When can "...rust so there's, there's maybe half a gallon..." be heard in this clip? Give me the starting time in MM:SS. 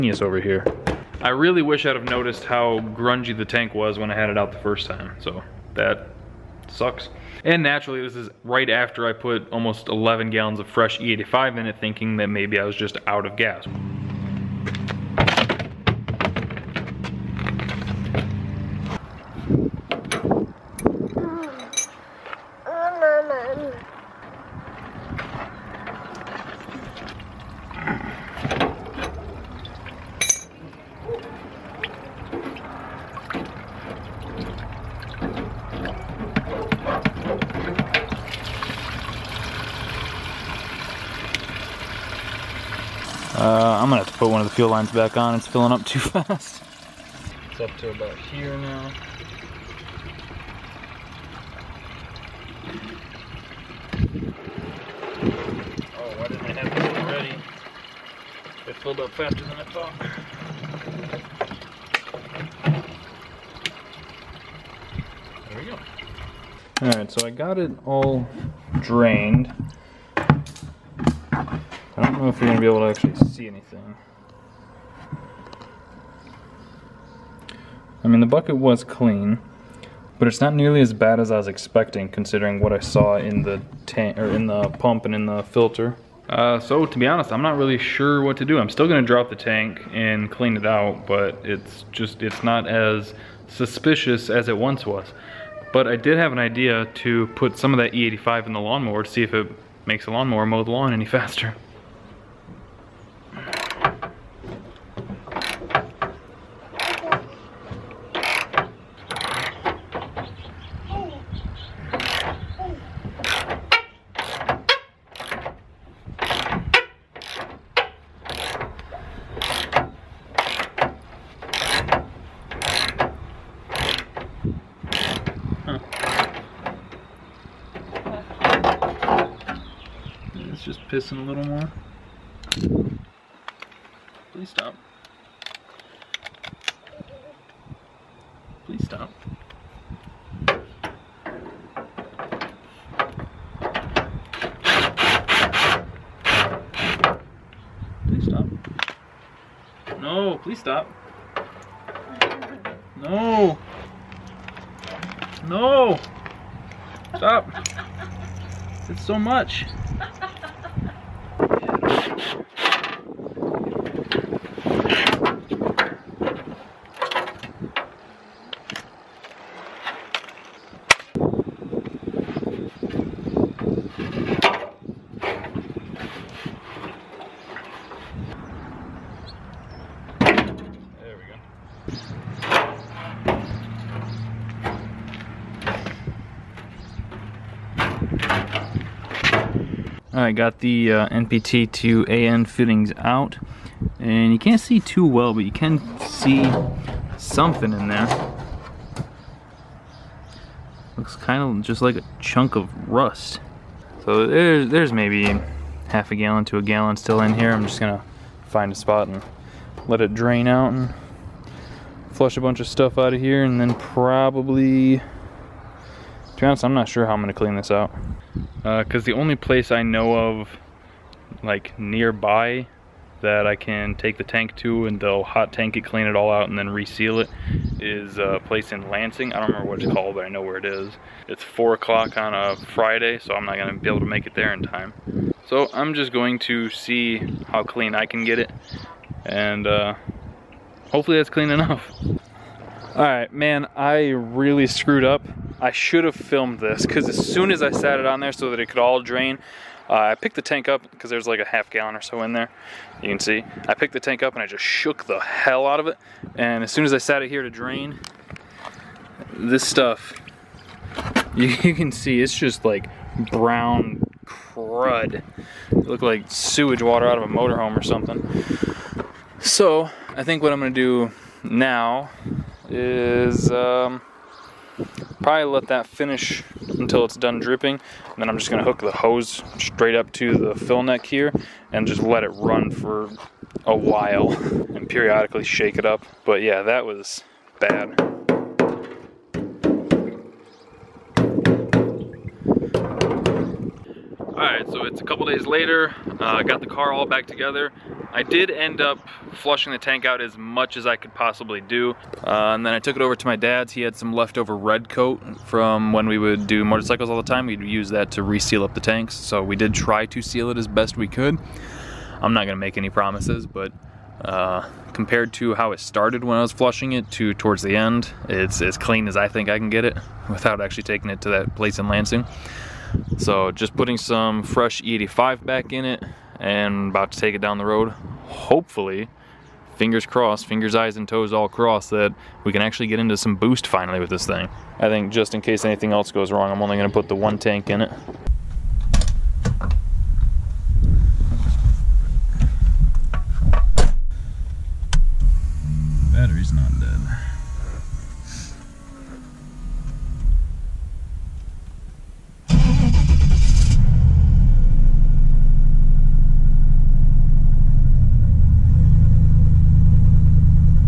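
03:22.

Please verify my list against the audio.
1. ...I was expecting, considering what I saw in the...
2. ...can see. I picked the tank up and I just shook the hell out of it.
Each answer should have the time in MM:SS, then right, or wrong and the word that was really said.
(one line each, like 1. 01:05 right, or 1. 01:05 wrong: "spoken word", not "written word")
1. 01:21 right
2. 04:13 right.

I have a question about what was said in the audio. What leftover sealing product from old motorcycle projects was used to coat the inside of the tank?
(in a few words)
Red Kote.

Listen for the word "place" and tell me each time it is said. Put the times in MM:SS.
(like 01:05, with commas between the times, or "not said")
03:39, 03:48, 05:21.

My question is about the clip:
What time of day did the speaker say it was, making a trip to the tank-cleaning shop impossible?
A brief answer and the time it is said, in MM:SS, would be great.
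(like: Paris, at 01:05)
4 o'clock on a Friday, at 03:51.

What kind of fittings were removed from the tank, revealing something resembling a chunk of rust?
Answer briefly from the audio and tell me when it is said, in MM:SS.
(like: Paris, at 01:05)
NPT to AN fittings, at 03:11.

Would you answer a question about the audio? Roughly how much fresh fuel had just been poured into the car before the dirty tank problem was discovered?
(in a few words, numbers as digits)
almost 11 gallons.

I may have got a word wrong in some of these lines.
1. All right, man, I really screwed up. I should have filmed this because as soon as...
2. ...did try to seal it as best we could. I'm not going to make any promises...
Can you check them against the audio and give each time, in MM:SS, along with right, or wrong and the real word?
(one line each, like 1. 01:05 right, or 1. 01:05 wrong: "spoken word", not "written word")
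1. 04:02 right
2. 05:09 right.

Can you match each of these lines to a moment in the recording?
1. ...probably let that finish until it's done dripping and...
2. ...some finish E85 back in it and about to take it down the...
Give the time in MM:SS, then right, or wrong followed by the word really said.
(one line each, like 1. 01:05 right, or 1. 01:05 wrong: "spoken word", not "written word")
1. 04:35 right
2. 05:23 wrong: "fresh", not "finish".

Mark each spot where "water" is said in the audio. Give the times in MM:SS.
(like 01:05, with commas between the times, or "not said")
04:26.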